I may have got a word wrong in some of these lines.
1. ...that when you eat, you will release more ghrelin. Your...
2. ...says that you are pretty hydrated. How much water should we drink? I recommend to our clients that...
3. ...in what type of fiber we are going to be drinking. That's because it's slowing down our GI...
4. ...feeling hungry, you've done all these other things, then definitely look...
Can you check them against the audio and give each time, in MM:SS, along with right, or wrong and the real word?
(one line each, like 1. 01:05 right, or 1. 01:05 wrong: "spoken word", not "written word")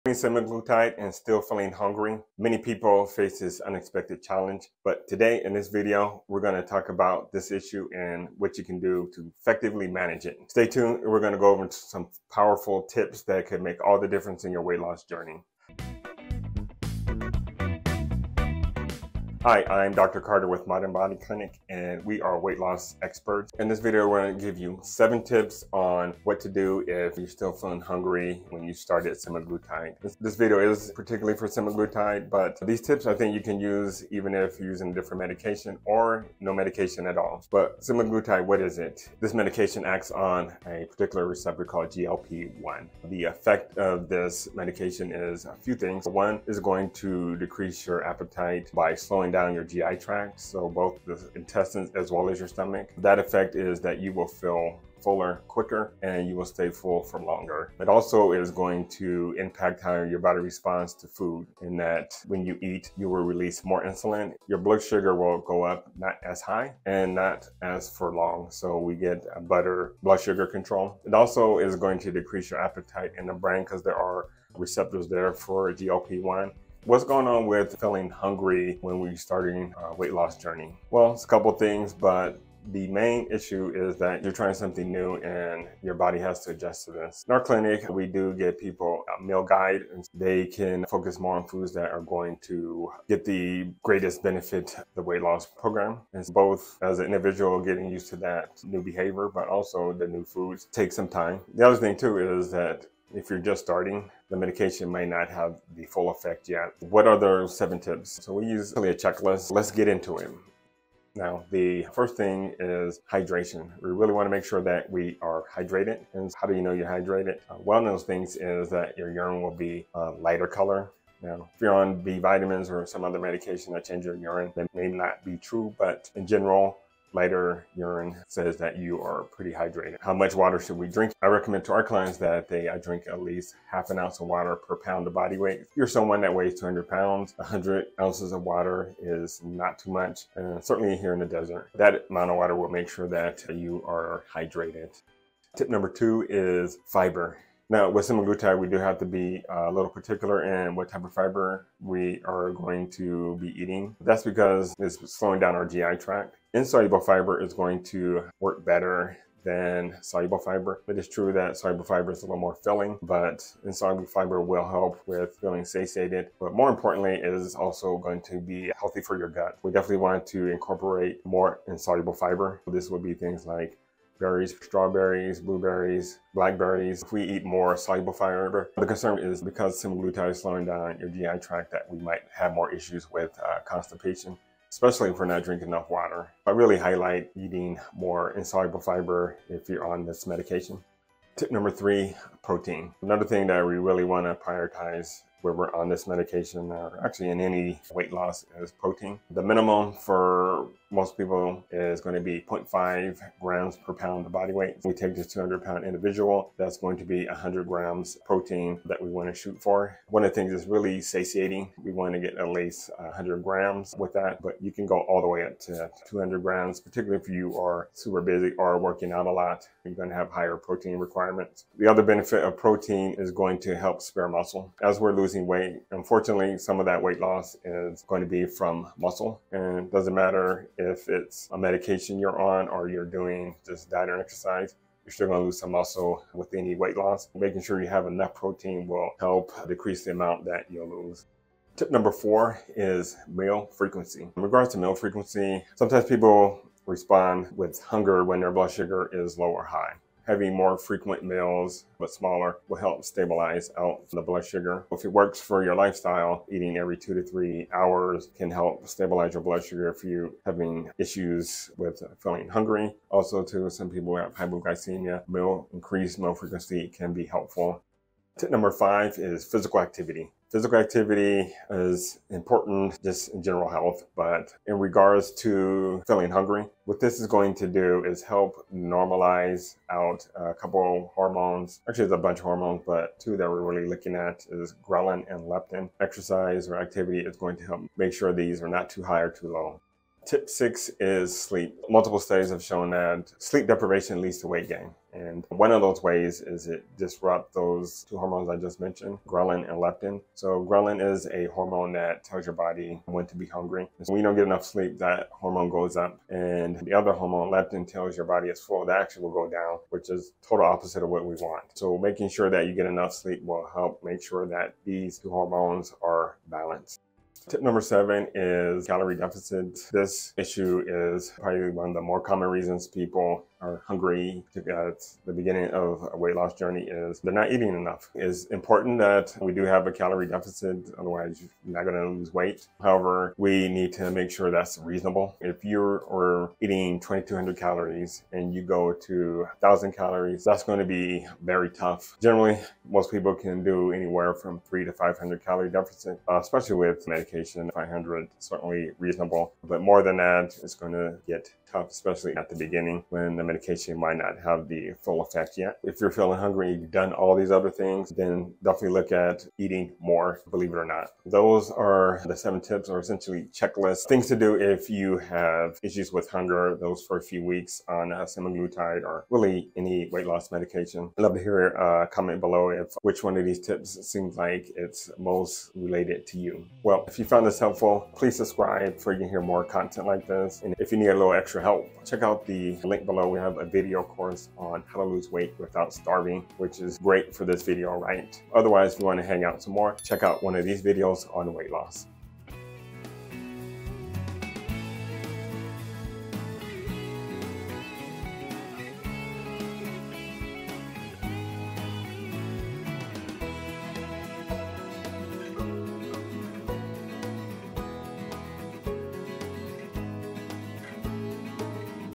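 1. 01:01 wrong: "insulin", not "ghrelin"
2. 02:08 right
3. 02:30 wrong: "eating", not "drinking"
4. 05:56 right.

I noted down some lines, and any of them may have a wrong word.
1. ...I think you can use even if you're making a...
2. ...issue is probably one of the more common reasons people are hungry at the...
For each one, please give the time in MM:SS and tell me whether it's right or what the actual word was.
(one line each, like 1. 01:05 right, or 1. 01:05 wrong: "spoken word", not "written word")
1. 00:33 wrong: "using", not "making"
2. 05:20 right.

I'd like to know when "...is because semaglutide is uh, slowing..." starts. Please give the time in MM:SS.
02:59.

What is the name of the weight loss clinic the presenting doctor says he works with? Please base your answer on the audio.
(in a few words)
Modern Body Clinic.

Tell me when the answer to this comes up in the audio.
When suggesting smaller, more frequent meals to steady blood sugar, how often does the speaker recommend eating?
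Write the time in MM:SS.
04:16.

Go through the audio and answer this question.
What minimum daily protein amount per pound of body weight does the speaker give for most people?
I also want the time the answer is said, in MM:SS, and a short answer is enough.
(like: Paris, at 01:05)
0.5 grams, at 03:22.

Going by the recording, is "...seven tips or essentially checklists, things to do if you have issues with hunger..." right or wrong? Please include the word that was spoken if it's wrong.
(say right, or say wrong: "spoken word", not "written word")
right.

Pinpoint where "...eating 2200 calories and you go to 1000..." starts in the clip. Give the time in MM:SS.
05:36.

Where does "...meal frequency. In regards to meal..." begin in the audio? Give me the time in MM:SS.
04:03.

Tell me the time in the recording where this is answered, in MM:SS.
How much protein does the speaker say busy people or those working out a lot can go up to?
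03:36.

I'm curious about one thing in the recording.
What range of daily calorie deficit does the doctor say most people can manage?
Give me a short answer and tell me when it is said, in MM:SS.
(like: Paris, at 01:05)
300 to 500 calories, at 05:44.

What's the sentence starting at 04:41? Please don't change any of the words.
Actually, there's a bunch of hormones, but two that we're really looking at is ghrelin and leptin.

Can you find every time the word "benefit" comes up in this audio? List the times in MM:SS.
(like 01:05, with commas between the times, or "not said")
01:34, 03:42.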